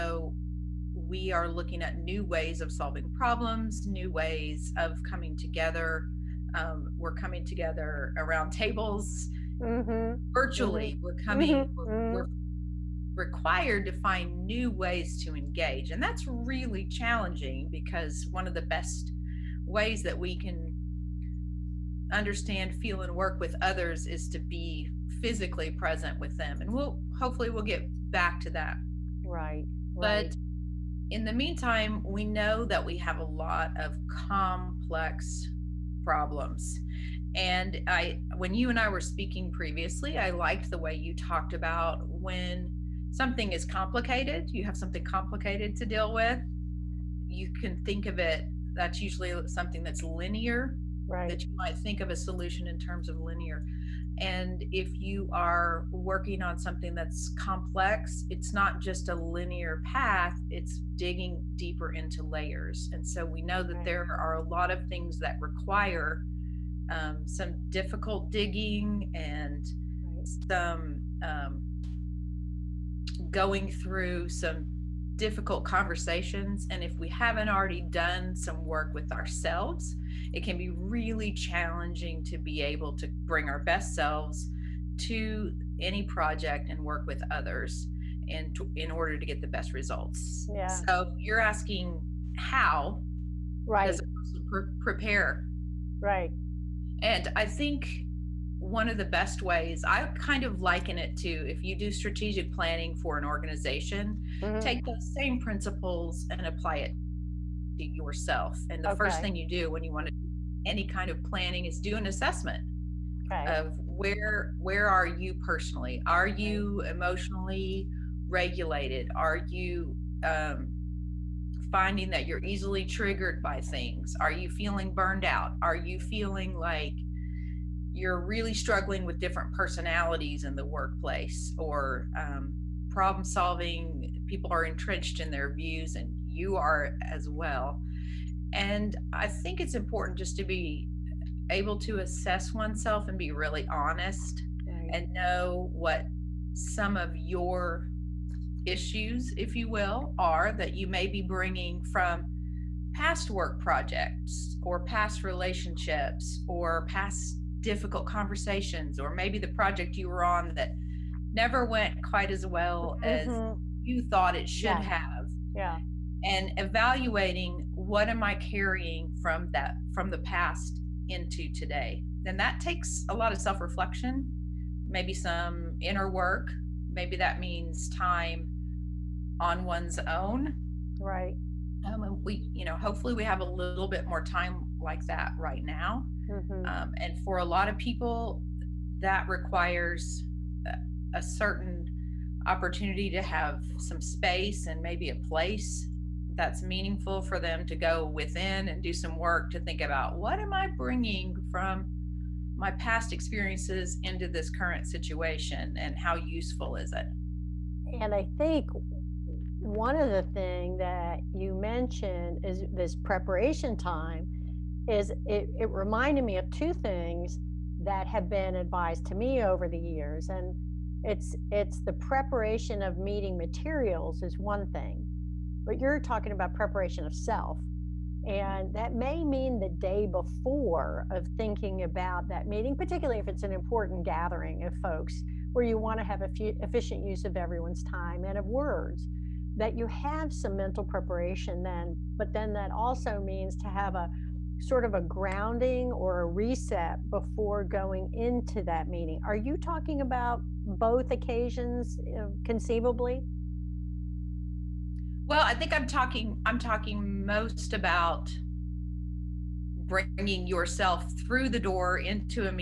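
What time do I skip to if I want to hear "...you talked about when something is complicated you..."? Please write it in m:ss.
0:40.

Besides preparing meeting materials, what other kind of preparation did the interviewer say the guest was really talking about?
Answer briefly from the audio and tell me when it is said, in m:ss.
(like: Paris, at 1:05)
preparation of self, at 3:46.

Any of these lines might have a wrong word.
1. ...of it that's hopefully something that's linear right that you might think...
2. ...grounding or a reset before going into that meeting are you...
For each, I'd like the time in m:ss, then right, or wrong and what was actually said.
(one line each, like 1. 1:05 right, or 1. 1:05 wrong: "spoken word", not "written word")
1. 0:48 wrong: "usually", not "hopefully"
2. 4:05 right.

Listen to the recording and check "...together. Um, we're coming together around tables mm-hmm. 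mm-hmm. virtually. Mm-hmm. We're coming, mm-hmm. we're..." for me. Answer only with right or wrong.
right.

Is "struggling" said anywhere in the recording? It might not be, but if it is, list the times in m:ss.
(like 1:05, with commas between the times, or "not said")
2:08.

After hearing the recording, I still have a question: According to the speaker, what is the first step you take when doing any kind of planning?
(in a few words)
an assessment.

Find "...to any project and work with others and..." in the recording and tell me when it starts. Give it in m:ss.
1:24.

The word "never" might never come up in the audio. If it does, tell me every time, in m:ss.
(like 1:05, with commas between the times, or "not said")
2:41.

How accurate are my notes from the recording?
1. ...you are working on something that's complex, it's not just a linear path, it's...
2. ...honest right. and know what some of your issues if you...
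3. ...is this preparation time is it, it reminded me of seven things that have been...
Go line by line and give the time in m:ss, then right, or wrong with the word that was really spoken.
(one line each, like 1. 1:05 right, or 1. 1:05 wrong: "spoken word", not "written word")
1. 0:54 right
2. 2:23 right
3. 3:32 wrong: "two", not "seven".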